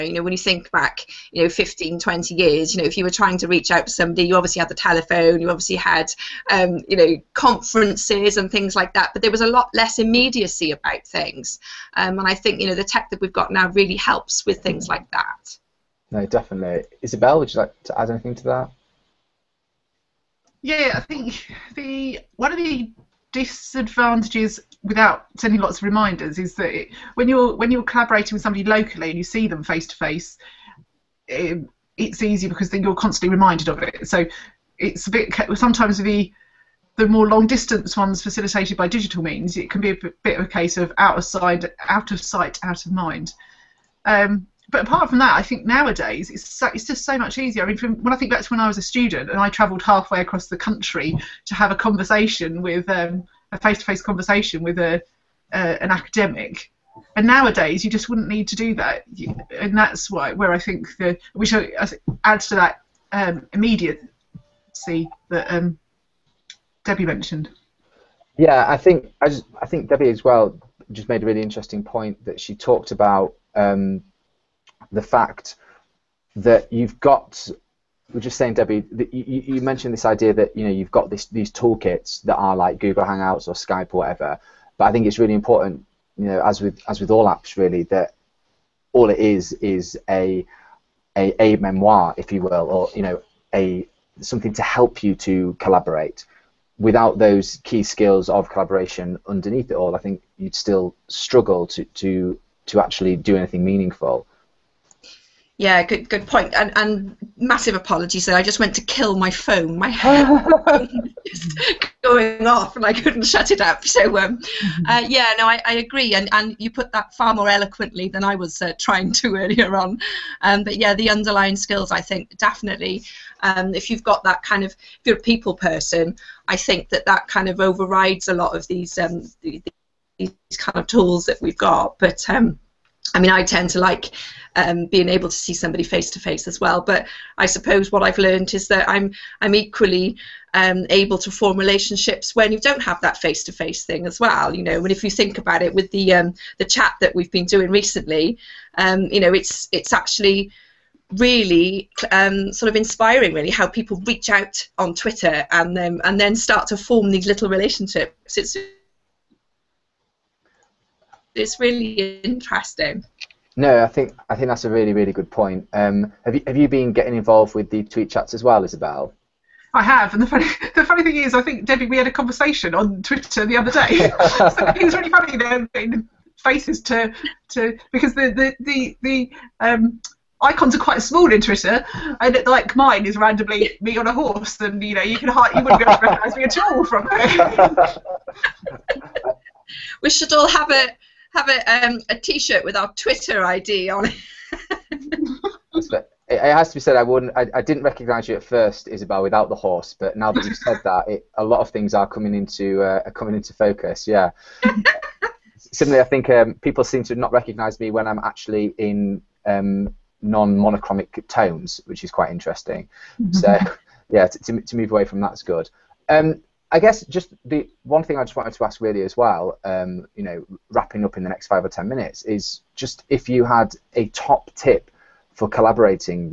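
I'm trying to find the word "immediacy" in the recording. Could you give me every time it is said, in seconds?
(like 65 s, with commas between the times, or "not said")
9 s, 63 s.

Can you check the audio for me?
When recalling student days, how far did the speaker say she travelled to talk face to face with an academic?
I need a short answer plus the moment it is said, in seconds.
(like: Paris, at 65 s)
Halfway across the country, at 49 s.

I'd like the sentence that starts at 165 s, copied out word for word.
Um, have you have you been getting involved with the tweet chats as well, Isabel?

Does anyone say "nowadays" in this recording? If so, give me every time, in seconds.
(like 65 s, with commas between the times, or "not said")
45 s, 57 s.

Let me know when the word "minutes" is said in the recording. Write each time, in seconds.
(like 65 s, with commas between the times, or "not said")
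221 s.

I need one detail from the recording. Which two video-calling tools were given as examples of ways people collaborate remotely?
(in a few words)
Google Hangouts or Skype.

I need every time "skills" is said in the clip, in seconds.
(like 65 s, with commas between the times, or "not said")
97 s, 121 s.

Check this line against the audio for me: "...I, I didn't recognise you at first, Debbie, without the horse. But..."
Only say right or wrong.
wrong.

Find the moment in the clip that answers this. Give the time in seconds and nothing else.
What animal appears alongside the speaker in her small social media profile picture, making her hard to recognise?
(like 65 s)
184 s.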